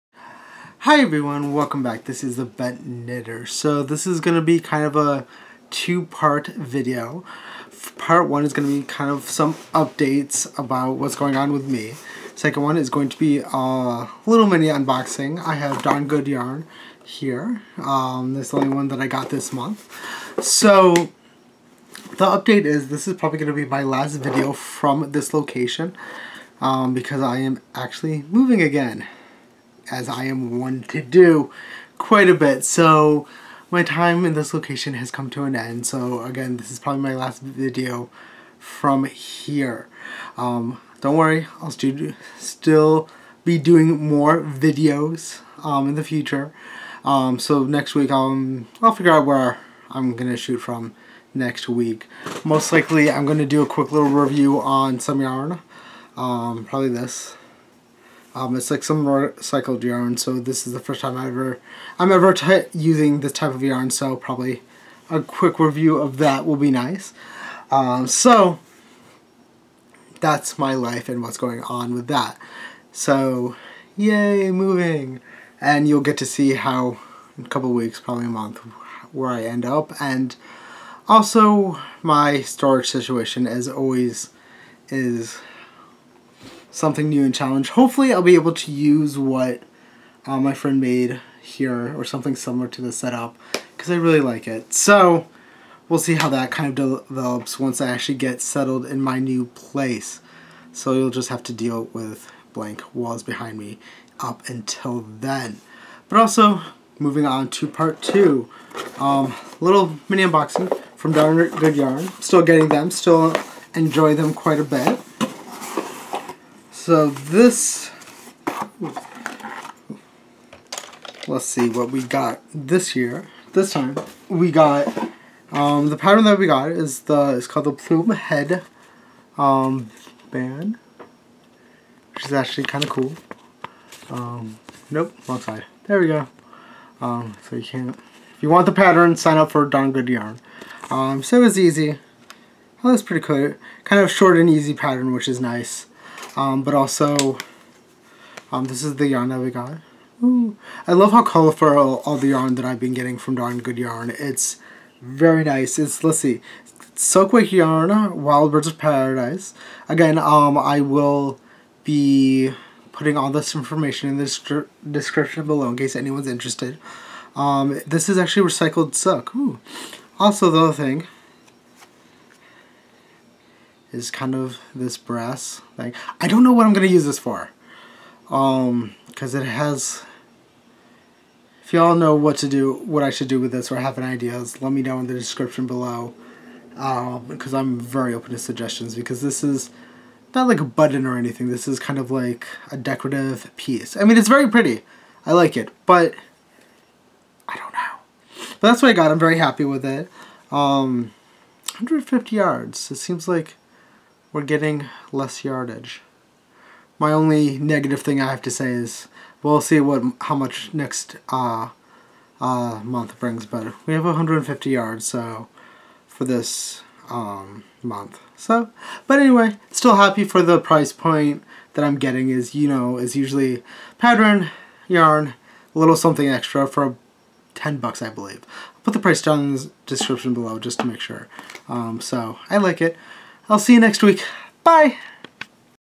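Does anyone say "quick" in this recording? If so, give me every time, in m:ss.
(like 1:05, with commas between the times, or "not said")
0:53, 1:05.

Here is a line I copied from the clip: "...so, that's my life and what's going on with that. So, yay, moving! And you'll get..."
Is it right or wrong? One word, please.
right.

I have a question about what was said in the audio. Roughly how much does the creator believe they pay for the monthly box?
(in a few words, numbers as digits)
$10.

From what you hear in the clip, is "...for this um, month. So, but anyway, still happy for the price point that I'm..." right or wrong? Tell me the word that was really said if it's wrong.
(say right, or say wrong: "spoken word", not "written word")
right.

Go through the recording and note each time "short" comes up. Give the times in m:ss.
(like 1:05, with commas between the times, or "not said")
2:24.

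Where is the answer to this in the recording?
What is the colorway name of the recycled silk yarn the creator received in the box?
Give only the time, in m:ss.
2:38.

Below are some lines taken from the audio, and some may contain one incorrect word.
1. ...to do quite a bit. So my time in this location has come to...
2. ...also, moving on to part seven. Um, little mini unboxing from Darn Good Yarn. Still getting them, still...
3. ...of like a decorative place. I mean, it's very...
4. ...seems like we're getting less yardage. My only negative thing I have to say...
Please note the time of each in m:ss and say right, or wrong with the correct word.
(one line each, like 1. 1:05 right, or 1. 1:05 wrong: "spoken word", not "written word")
1. 0:30 right
2. 1:46 wrong: "two", not "seven"
3. 3:11 wrong: "piece", not "place"
4. 3:22 right.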